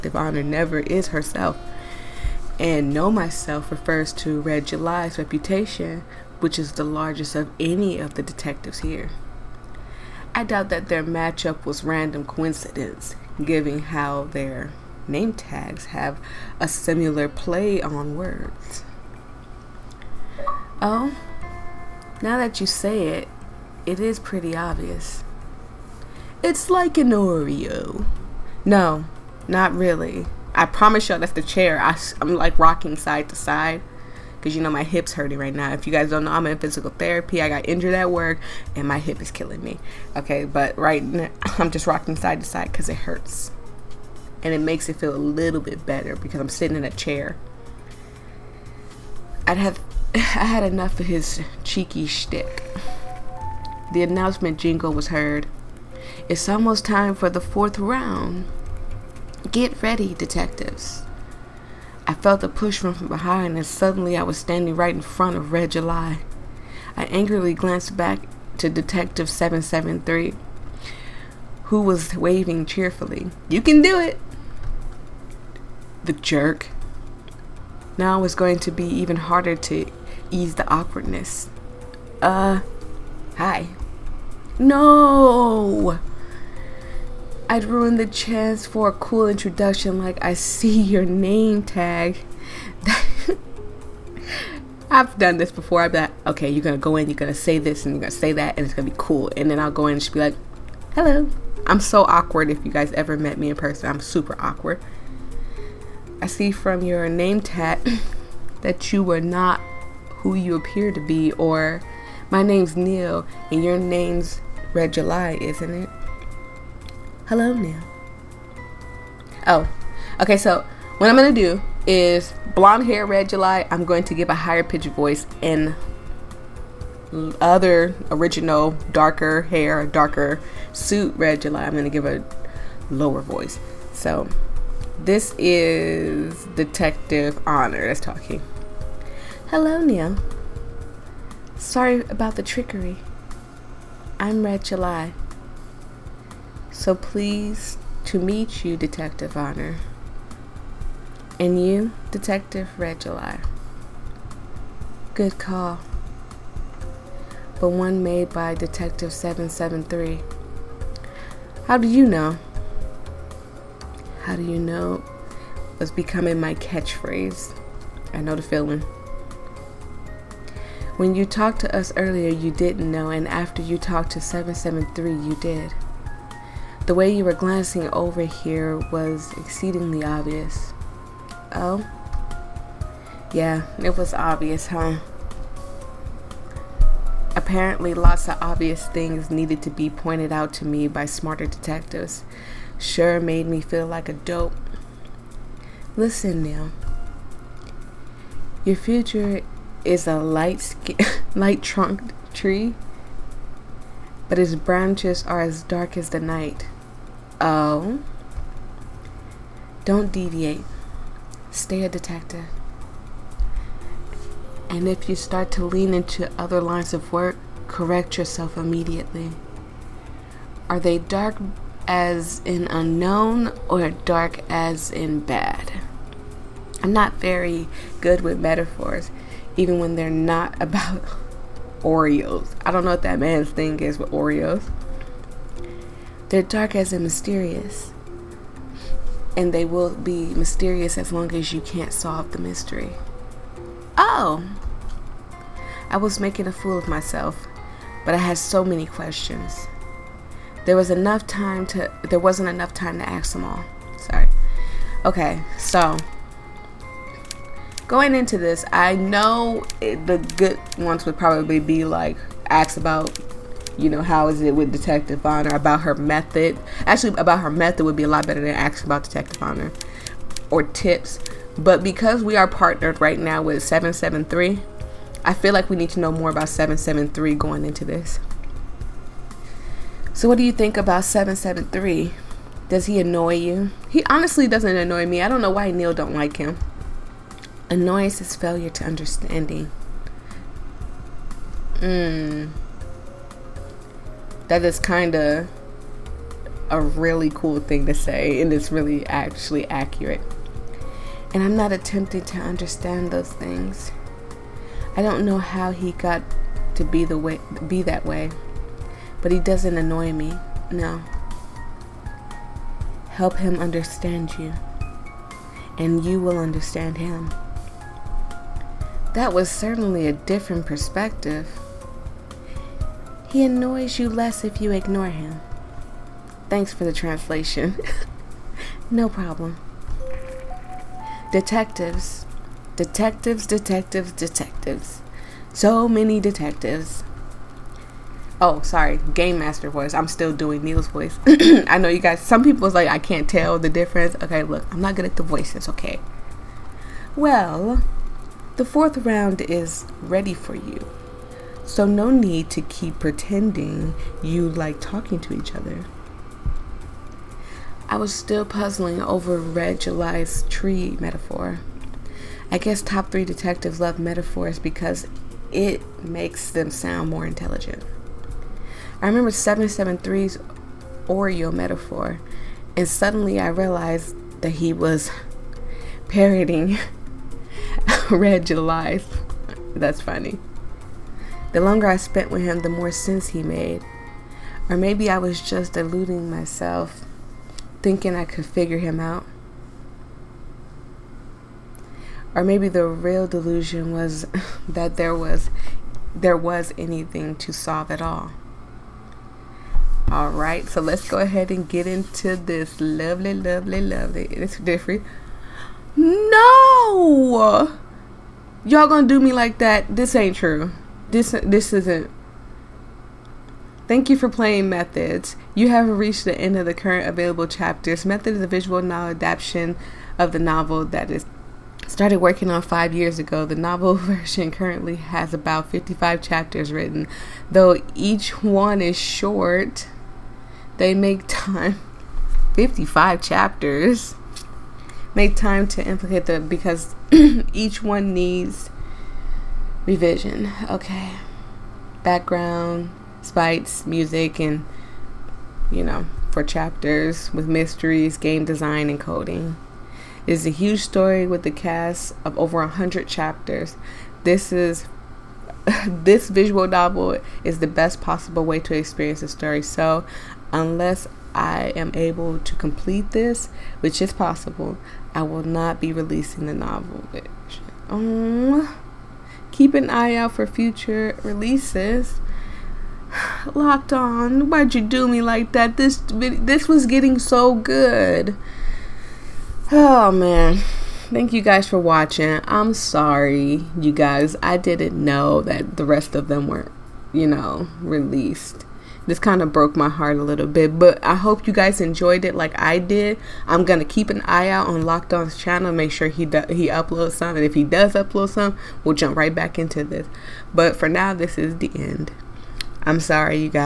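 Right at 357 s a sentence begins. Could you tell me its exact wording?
I was still puzzling over Red July's tree metaphor.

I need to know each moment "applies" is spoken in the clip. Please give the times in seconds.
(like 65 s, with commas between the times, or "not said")
not said.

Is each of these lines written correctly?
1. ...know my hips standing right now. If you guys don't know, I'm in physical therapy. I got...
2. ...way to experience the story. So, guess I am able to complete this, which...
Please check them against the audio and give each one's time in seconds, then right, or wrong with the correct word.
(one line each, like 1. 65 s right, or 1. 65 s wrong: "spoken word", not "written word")
1. 34 s wrong: "hurting", not "standing"
2. 458 s wrong: "unless", not "guess".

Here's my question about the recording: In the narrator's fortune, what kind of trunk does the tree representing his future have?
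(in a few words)
light trunked.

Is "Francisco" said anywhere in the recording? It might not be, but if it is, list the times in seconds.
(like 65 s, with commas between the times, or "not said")
not said.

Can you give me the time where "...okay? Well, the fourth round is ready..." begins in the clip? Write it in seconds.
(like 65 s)
345 s.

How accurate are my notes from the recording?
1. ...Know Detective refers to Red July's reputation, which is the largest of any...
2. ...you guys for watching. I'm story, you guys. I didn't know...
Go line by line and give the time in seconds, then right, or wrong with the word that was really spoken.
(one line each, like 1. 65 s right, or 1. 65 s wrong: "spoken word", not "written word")
1. 2 s wrong: "Myself", not "Detective"
2. 481 s wrong: "sorry", not "story".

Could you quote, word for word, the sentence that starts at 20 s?
Oh, now that you say it, it is pretty obvious.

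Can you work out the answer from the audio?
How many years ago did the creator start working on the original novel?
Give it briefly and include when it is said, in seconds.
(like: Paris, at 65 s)
5, at 422 s.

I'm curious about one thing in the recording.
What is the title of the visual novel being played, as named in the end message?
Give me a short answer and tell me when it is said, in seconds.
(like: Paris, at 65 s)
Methods, at 414 s.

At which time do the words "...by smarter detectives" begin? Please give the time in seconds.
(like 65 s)
190 s.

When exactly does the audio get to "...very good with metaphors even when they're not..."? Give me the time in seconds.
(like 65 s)
227 s.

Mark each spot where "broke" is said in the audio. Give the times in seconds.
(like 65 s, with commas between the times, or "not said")
489 s.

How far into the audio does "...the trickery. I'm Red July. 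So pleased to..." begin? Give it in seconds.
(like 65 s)
142 s.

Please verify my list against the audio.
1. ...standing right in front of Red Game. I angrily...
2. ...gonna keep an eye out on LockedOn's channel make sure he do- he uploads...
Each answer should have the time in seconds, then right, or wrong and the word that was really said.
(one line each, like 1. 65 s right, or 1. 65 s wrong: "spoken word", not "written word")
1. 64 s wrong: "July", not "Game"
2. 493 s right.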